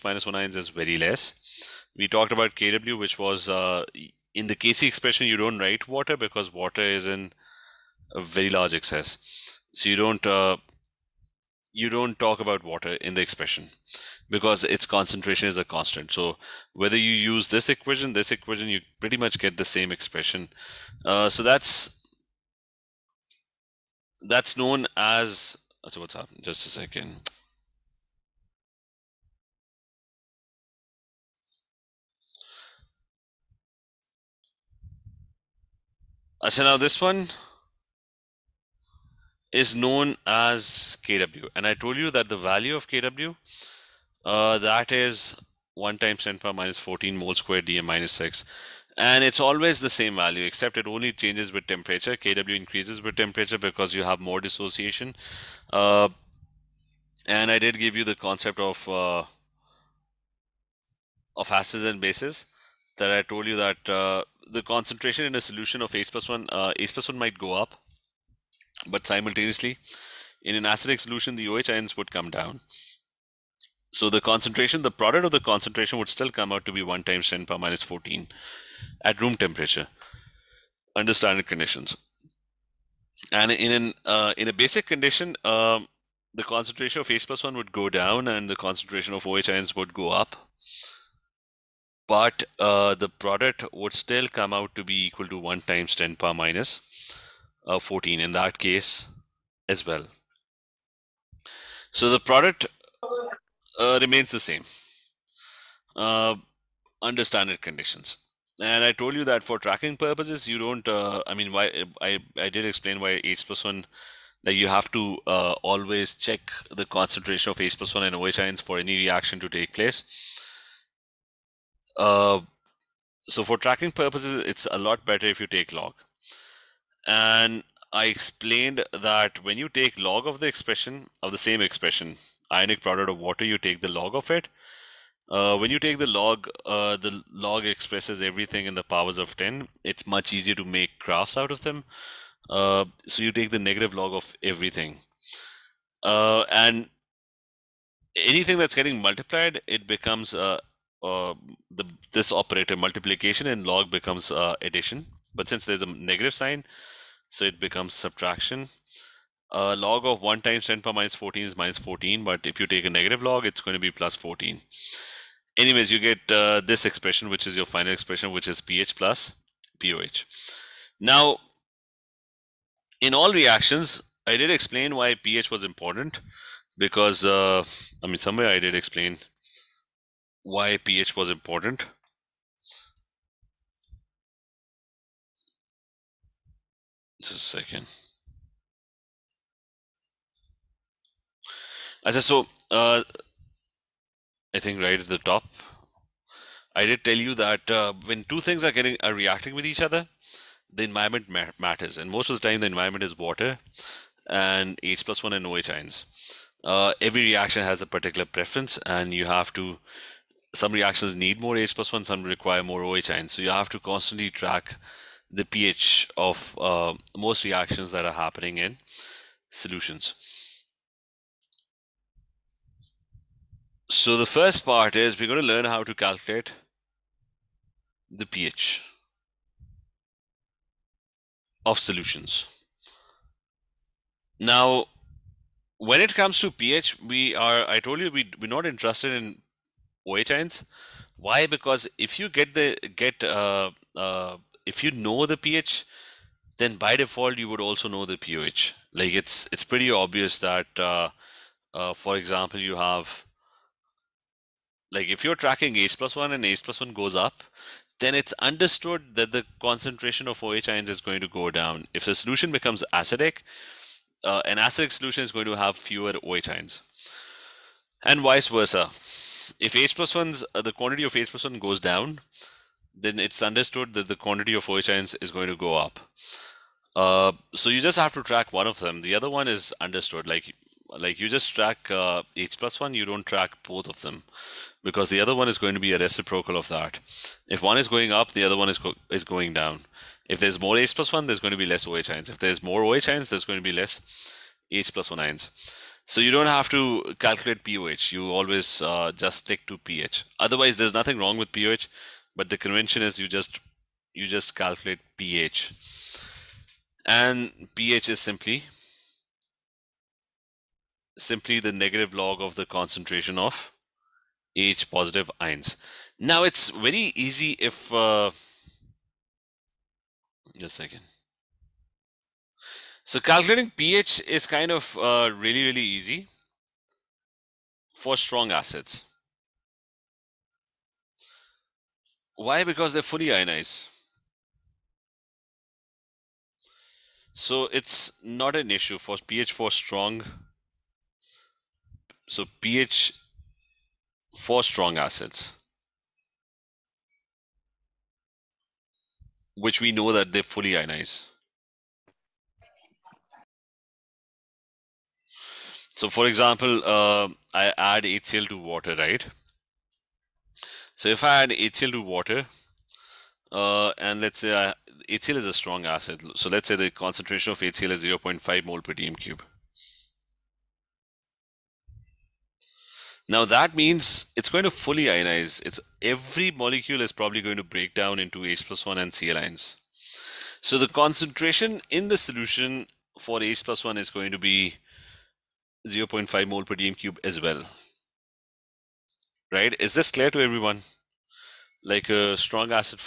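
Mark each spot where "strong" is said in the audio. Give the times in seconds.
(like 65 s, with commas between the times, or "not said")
328 s, 339 s, 344 s, 365 s, 392 s.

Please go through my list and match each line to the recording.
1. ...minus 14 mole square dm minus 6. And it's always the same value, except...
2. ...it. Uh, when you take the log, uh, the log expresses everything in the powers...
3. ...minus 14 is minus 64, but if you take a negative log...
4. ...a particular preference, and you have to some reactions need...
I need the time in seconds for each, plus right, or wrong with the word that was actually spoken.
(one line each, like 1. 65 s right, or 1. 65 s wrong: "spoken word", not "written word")
1. 46 s right
2. 134 s right
3. 160 s wrong: "14", not "64"
4. 207 s right.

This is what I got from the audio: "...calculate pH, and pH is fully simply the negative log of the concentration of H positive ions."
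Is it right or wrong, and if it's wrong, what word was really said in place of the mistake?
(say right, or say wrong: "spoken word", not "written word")
wrong: "simply", not "fully".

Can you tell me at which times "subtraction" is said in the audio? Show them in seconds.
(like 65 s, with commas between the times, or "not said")
157 s.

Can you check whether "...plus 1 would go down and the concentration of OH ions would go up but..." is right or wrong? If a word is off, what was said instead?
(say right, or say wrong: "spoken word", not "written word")
right.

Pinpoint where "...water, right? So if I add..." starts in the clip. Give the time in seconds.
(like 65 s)
358 s.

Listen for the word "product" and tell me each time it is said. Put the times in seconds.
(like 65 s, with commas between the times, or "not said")
74 s, 93 s, 102 s, 132 s.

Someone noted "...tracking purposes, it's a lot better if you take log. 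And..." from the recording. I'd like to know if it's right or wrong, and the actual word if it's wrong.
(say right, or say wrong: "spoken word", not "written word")
right.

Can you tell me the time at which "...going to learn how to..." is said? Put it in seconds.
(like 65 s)
225 s.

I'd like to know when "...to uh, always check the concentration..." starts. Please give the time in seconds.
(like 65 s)
114 s.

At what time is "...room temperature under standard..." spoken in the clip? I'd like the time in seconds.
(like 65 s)
79 s.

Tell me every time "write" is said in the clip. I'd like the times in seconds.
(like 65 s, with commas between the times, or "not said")
5 s.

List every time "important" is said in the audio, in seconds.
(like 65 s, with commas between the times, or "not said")
175 s, 181 s.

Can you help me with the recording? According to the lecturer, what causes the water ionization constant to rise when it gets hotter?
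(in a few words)
More dissociation.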